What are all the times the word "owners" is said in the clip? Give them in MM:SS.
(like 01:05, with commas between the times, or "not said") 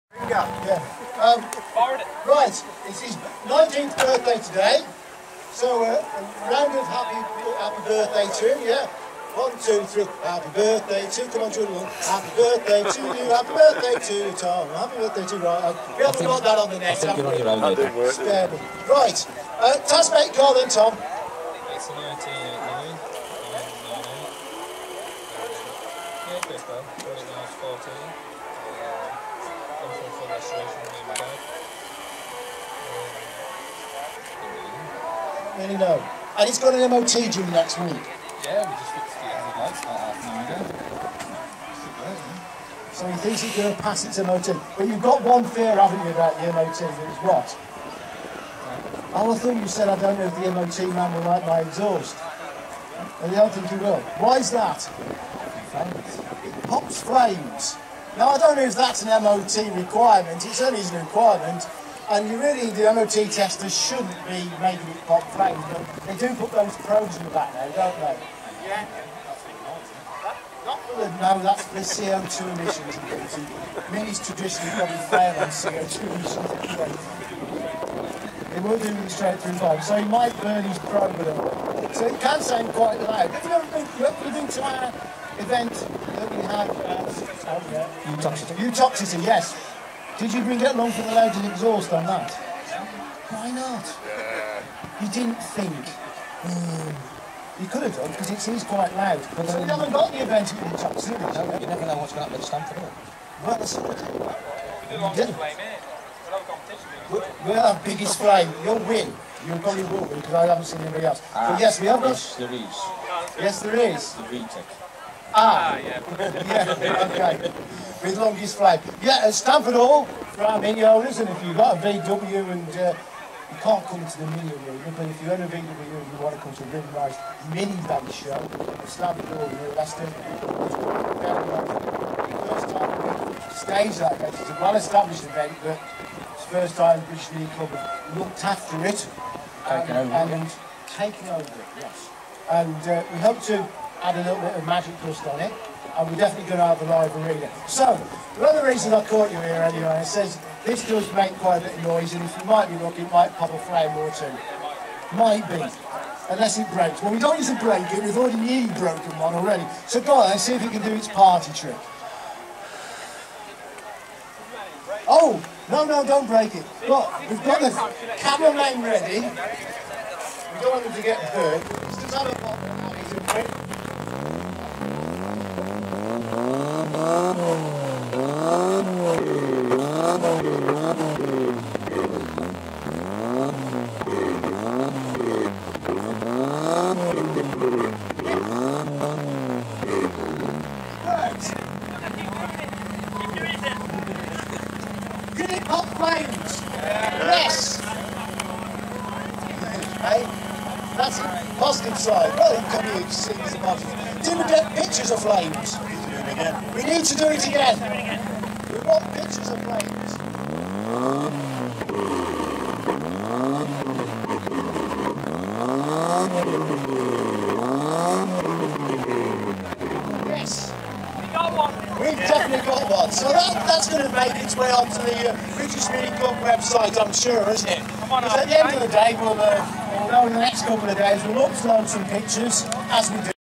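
02:00.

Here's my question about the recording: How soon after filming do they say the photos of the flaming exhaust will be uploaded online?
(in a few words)
next couple of days.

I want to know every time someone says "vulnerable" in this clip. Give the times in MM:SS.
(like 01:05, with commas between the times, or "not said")
not said.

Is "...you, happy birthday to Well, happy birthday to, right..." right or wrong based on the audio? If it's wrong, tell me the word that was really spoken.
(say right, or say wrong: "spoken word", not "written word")
wrong: "Tom", not "Well".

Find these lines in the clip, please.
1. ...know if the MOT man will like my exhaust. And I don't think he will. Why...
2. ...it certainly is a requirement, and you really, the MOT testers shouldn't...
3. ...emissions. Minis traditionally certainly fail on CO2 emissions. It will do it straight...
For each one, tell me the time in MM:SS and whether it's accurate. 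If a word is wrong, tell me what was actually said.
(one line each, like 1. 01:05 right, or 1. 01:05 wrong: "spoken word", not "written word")
1. 00:50 right
2. 01:00 right
3. 01:12 wrong: "probably", not "certainly".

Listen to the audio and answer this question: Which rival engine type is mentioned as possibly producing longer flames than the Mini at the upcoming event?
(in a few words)
VTEC.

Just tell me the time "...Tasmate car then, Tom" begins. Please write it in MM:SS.
00:19.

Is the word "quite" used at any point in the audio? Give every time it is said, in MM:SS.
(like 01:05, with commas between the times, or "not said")
01:22, 01:38, 02:31.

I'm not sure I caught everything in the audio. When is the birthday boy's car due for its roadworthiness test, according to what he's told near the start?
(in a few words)
next week.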